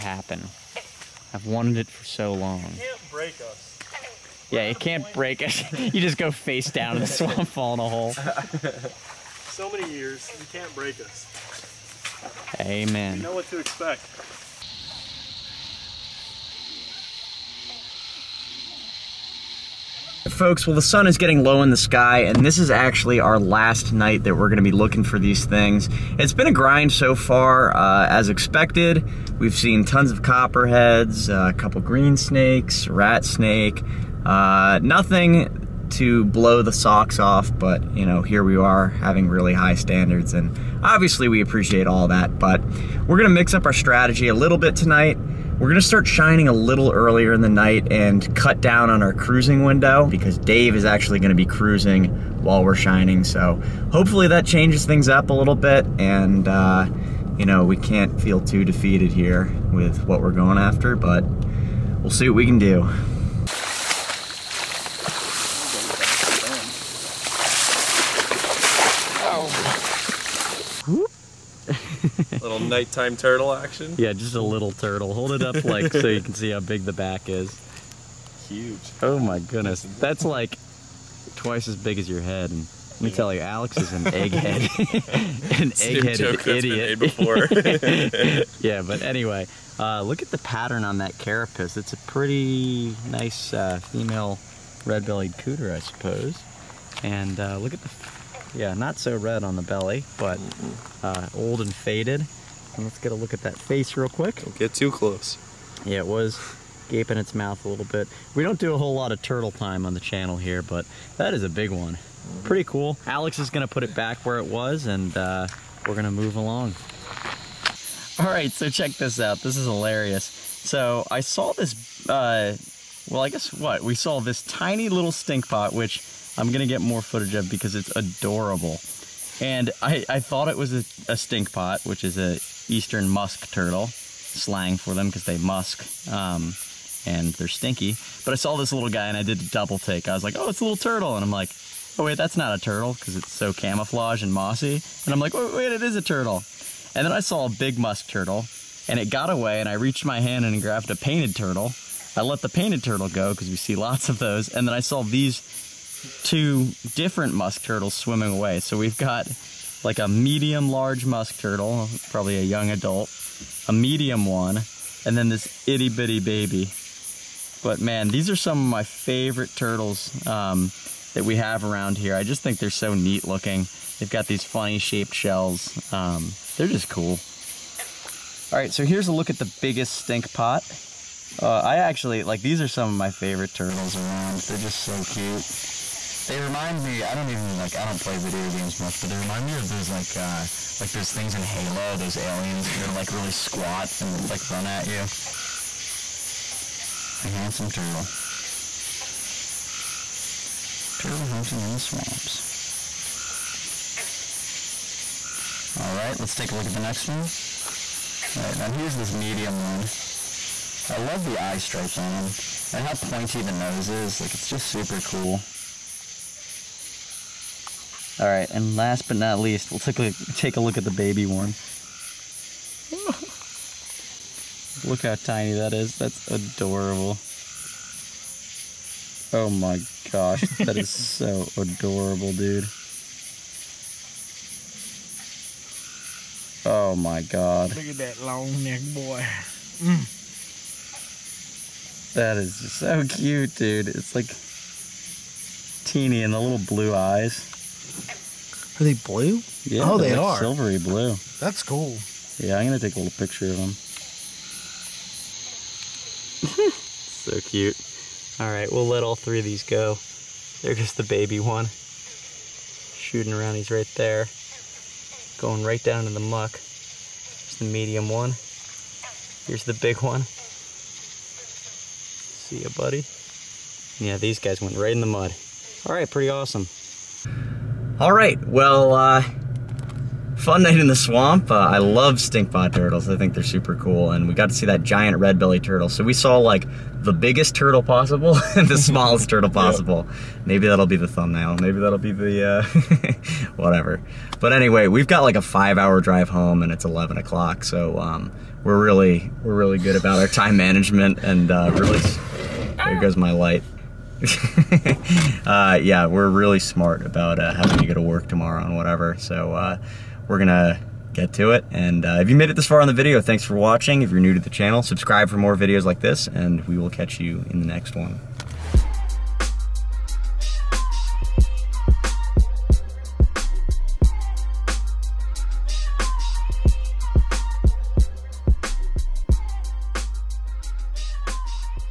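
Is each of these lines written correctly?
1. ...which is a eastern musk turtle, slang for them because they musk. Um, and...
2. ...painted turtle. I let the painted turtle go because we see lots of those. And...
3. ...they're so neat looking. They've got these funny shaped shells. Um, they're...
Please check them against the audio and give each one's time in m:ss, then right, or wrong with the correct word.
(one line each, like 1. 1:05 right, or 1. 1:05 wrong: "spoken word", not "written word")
1. 2:11 right
2. 2:30 right
3. 2:52 right.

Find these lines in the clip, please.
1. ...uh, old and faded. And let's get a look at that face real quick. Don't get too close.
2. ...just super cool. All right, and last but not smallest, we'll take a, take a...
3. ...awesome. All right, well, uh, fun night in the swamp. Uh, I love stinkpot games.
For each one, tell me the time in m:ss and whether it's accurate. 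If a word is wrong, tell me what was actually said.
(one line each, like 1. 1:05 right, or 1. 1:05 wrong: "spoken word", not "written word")
1. 1:41 right
2. 3:34 wrong: "least", not "smallest"
3. 4:36 wrong: "turtles", not "games".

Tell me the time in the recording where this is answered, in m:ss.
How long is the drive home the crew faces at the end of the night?
4:55.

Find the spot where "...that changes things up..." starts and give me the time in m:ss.
0:54.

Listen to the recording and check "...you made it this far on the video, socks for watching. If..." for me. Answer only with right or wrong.
wrong.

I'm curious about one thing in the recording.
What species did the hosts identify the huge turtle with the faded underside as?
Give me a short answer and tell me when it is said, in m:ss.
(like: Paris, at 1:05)
red-bellied cooter, at 1:34.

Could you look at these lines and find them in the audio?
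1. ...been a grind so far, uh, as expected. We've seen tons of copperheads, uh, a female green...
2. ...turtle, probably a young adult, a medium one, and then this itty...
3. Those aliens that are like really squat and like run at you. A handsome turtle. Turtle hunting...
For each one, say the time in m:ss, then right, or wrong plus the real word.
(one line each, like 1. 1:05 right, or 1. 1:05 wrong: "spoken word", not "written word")
1. 0:26 wrong: "couple", not "female"
2. 2:41 right
3. 3:11 right.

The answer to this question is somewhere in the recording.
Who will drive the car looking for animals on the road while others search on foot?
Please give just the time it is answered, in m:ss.
0:50.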